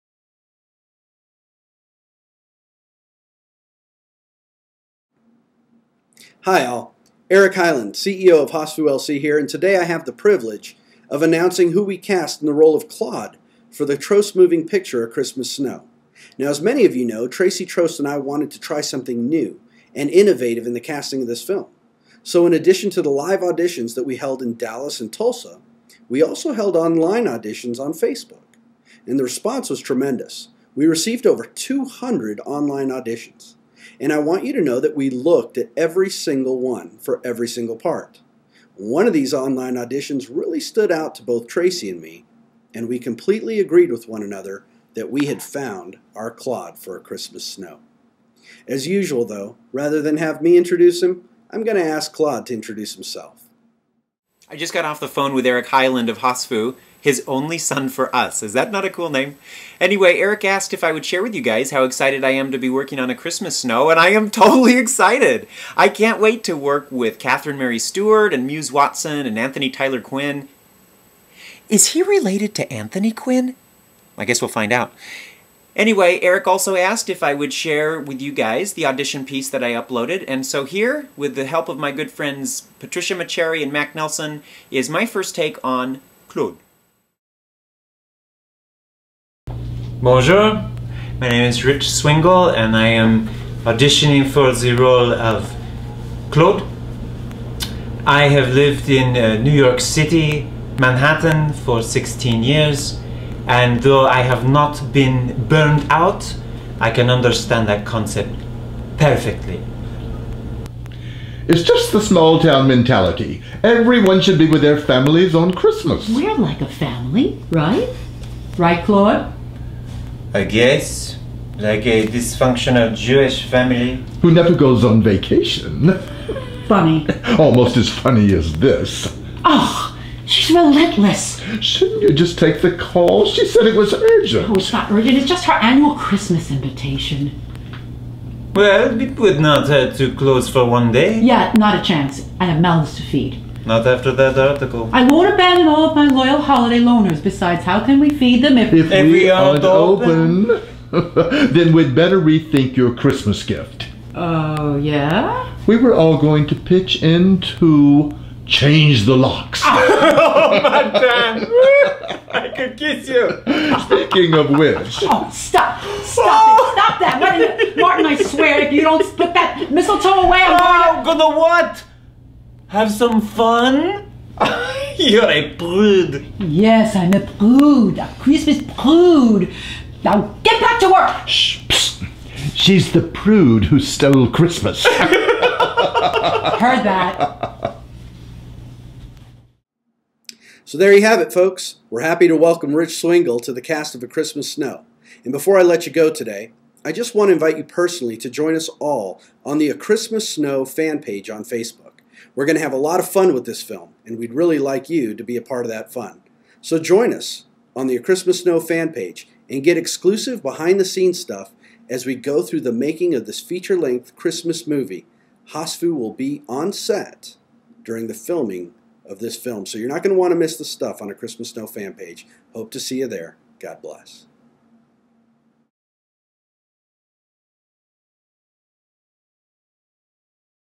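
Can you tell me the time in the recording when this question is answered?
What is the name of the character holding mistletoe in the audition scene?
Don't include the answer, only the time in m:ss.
2:47.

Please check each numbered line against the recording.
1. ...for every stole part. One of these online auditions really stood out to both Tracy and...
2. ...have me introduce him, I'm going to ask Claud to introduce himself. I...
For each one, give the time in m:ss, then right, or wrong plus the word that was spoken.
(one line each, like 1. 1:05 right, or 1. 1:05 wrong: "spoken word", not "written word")
1. 0:36 wrong: "single", not "stole"
2. 0:50 right.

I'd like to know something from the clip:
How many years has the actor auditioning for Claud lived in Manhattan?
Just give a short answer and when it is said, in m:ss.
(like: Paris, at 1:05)
16, at 1:41.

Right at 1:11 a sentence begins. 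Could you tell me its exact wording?
Is he related to Anthony Quinn?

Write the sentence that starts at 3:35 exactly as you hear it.
Hosfu will be on set during the filming of this film.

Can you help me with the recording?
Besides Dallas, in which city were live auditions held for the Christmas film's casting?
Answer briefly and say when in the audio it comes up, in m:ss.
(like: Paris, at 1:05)
Tulsa, at 0:25.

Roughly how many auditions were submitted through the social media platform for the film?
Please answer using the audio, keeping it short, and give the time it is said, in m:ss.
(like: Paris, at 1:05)
over 200, at 0:31.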